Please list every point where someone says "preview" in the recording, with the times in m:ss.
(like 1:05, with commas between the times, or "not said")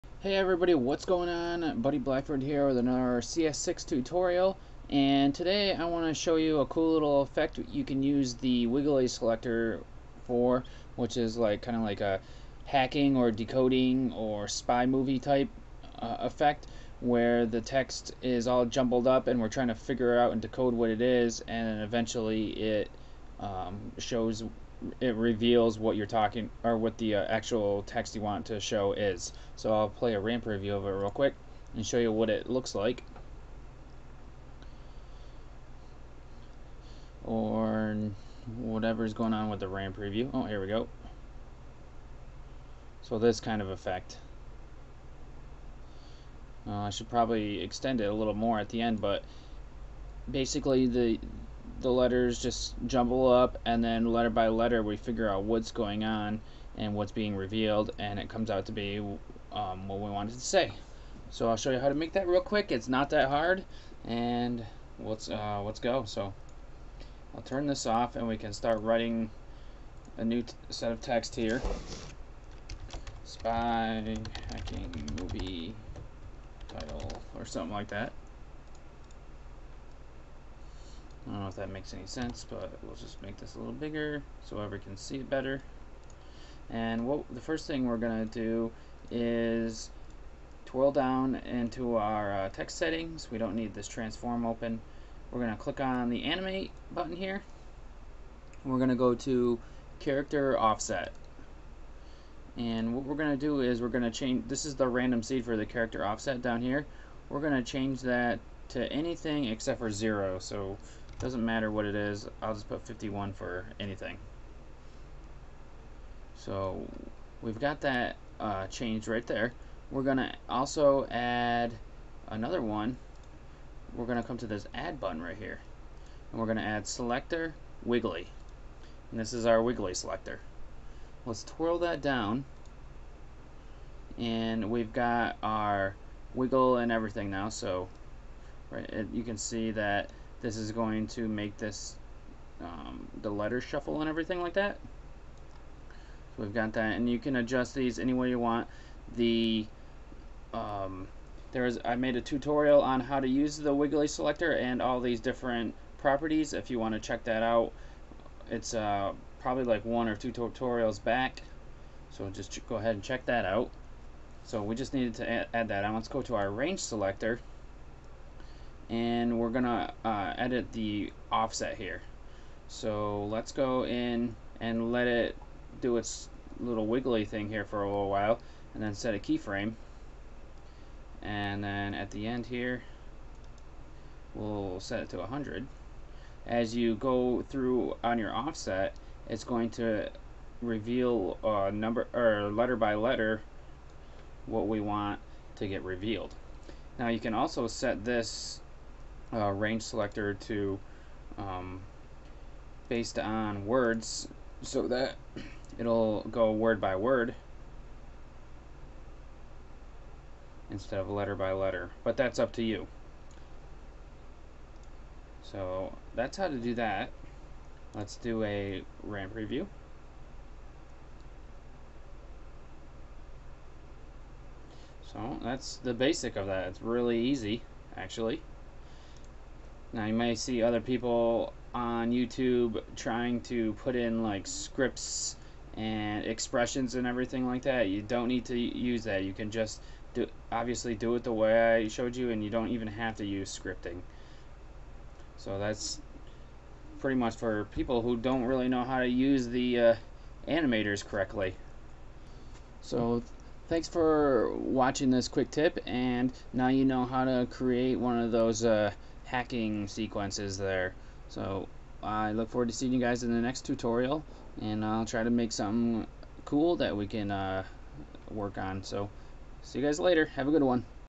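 0:30, 0:39, 3:39.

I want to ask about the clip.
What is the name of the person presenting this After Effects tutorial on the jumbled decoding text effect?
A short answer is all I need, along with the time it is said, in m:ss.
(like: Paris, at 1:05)
Buddy Blackford, at 0:01.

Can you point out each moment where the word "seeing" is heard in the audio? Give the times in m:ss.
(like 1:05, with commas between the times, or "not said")
4:22.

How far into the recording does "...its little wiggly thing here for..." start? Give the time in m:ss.
2:55.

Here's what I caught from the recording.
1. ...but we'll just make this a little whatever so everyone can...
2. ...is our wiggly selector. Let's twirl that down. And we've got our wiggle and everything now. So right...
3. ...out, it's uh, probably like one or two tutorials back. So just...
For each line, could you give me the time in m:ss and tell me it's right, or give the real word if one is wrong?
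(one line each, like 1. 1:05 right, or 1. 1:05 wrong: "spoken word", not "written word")
1. 1:22 wrong: "bigger", not "whatever"
2. 2:09 right
3. 2:37 right.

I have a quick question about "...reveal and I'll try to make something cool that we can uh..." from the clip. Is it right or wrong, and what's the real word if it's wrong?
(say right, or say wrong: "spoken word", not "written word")
wrong: "tutorial", not "reveal".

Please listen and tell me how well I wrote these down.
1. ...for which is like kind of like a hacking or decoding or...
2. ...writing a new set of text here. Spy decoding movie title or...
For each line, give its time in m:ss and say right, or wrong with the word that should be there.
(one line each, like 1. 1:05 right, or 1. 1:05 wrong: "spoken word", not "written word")
1. 0:10 right
2. 1:08 wrong: "hacking", not "decoding".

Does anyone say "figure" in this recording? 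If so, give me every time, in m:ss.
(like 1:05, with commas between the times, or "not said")
0:19, 0:54.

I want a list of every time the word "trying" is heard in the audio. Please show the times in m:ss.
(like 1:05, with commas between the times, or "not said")
0:19, 3:52.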